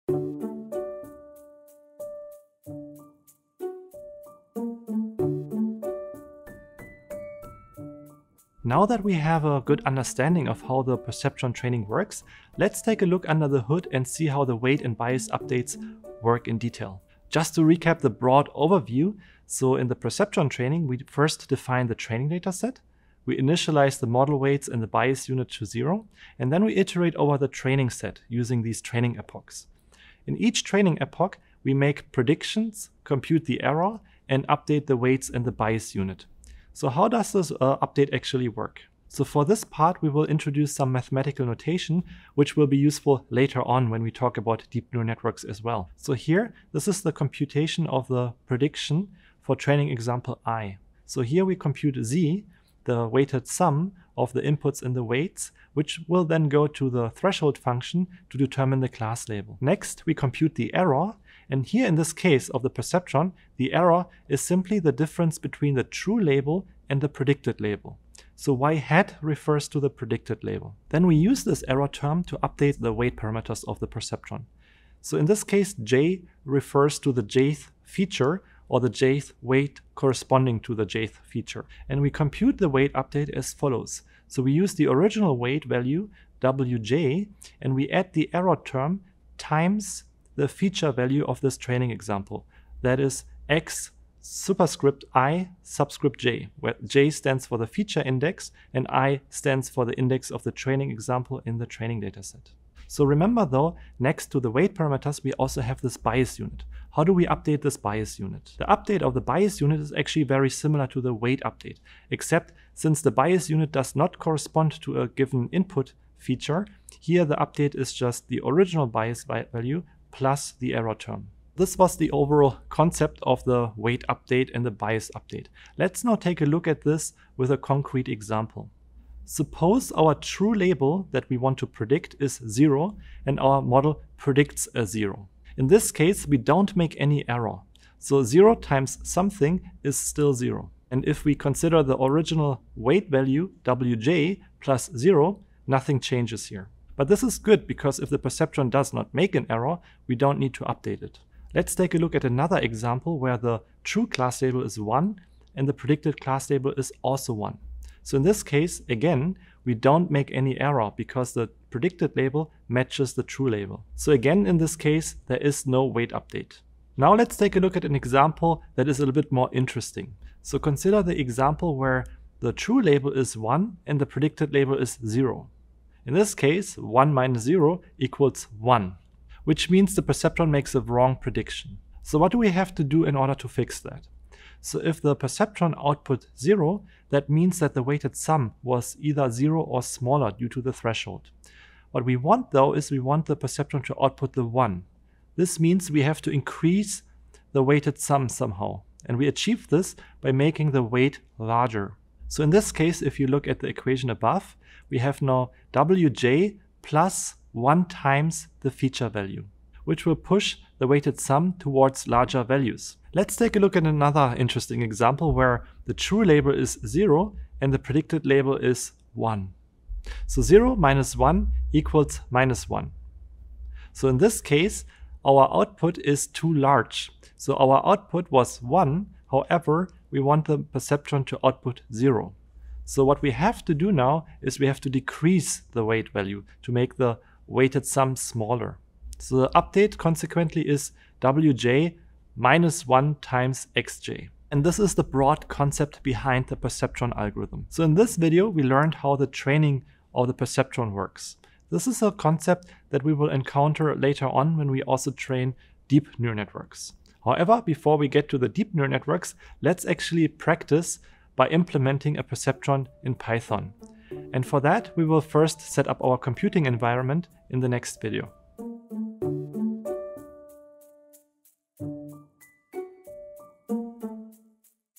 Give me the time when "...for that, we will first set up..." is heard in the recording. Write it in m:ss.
4:24.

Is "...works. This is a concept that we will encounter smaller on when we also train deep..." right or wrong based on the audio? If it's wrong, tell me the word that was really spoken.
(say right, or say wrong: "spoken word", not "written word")
wrong: "later", not "smaller".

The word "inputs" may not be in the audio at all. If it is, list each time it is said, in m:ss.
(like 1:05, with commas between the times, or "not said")
0:54, 1:55.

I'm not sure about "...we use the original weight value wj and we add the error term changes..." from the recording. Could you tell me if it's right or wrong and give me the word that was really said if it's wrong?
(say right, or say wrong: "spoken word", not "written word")
wrong: "times", not "changes".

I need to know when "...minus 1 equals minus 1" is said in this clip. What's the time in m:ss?
3:40.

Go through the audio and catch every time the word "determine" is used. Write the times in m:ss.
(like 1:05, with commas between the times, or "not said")
0:58.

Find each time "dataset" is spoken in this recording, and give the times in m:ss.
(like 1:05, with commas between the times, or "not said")
0:22, 1:42.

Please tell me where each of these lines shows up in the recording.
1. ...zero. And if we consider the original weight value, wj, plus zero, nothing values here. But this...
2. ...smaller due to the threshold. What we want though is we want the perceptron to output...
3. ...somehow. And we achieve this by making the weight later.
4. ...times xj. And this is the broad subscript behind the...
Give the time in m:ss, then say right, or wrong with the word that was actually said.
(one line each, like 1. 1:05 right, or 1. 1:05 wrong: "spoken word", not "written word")
1. 2:20 wrong: "changes", not "values"
2. 3:09 right
3. 3:18 wrong: "larger", not "later"
4. 4:03 wrong: "concept", not "subscript".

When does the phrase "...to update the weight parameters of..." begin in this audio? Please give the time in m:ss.
1:12.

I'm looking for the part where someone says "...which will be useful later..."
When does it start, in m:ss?
0:42.